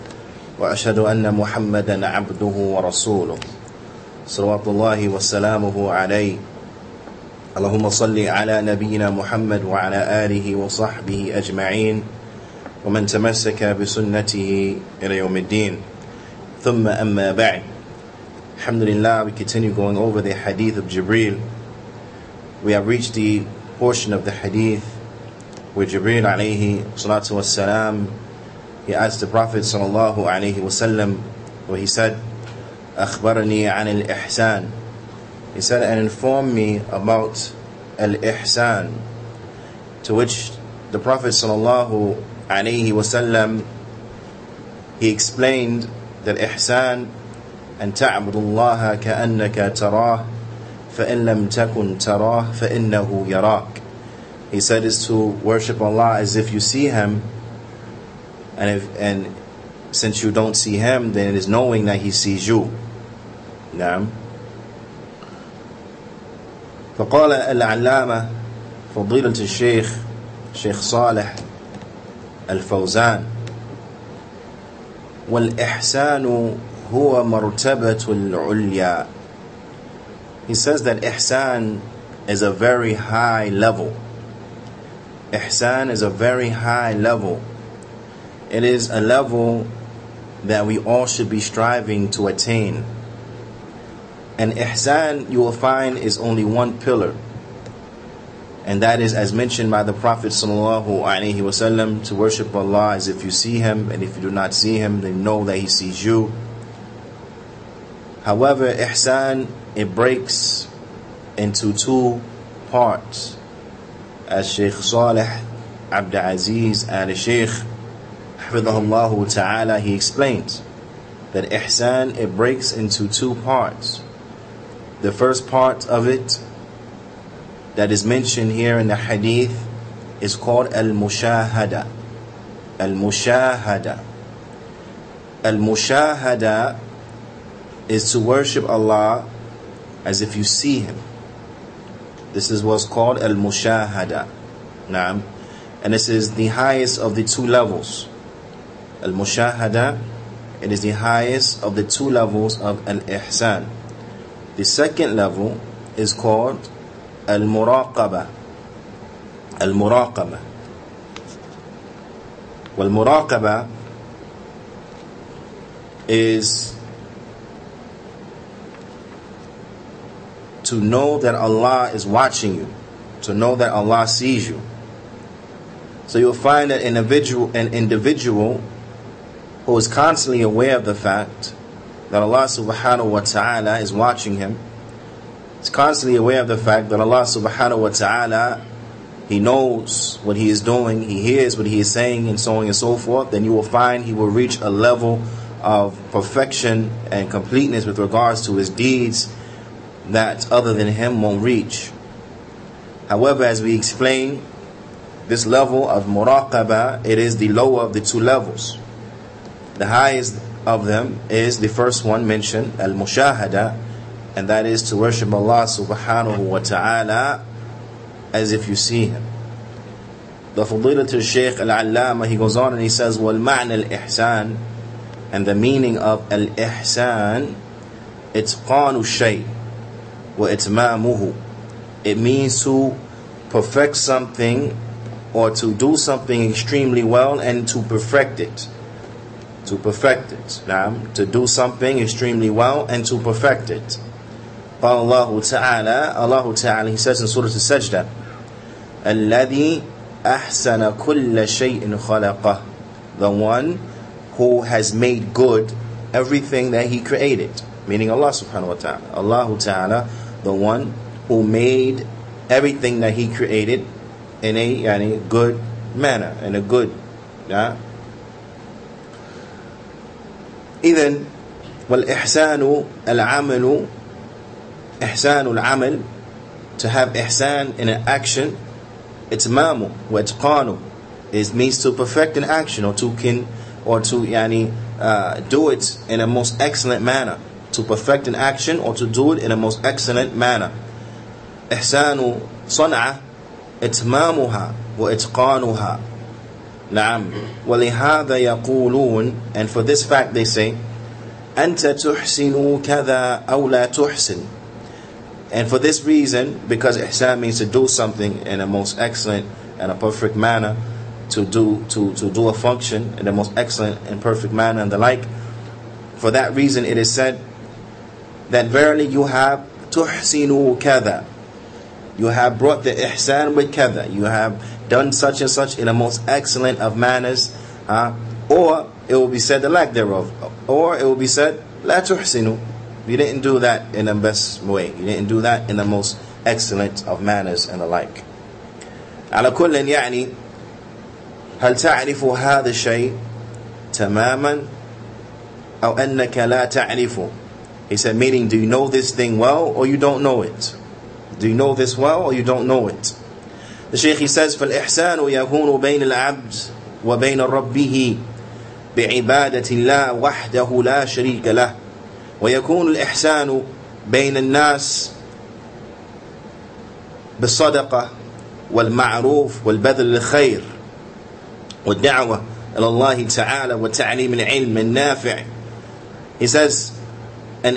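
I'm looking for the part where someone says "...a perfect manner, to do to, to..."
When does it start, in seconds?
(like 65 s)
309 s.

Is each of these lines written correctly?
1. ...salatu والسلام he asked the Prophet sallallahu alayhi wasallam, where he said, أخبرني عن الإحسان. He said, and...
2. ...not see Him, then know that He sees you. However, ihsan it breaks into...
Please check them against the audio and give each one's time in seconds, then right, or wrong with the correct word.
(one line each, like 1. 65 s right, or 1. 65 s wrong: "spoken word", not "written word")
1. 26 s right
2. 104 s right.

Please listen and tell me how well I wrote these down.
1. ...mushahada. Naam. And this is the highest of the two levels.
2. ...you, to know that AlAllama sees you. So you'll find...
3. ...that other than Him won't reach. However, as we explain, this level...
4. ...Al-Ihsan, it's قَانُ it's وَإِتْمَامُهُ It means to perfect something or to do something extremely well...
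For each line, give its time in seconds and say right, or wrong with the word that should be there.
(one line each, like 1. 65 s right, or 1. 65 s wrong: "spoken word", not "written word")
1. 143 s right
2. 172 s wrong: "Allah", not "AlAllama"
3. 200 s right
4. 226 s right.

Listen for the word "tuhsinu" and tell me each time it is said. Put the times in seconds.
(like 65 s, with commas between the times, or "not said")
319 s, 332 s.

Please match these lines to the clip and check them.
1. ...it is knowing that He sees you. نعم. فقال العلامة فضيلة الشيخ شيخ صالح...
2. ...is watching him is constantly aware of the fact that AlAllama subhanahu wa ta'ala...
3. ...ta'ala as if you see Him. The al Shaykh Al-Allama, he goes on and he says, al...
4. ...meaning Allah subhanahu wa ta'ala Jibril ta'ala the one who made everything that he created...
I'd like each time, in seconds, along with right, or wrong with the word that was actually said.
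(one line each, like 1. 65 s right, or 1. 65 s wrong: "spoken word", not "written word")
1. 61 s right
2. 183 s wrong: "Allah", not "AlAllama"
3. 216 s right
4. 257 s wrong: "Allah", not "Jibril".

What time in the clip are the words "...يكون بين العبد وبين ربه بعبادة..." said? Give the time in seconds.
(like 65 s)
355 s.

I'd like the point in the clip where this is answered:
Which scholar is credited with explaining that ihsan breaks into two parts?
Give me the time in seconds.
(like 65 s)
114 s.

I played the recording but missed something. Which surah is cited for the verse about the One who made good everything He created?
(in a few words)
Surah Al-Sajdah.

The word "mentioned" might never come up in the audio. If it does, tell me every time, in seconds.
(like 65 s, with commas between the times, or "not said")
99 s, 128 s, 212 s.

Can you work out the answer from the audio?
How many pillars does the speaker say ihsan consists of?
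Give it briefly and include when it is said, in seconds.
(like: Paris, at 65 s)
1, at 96 s.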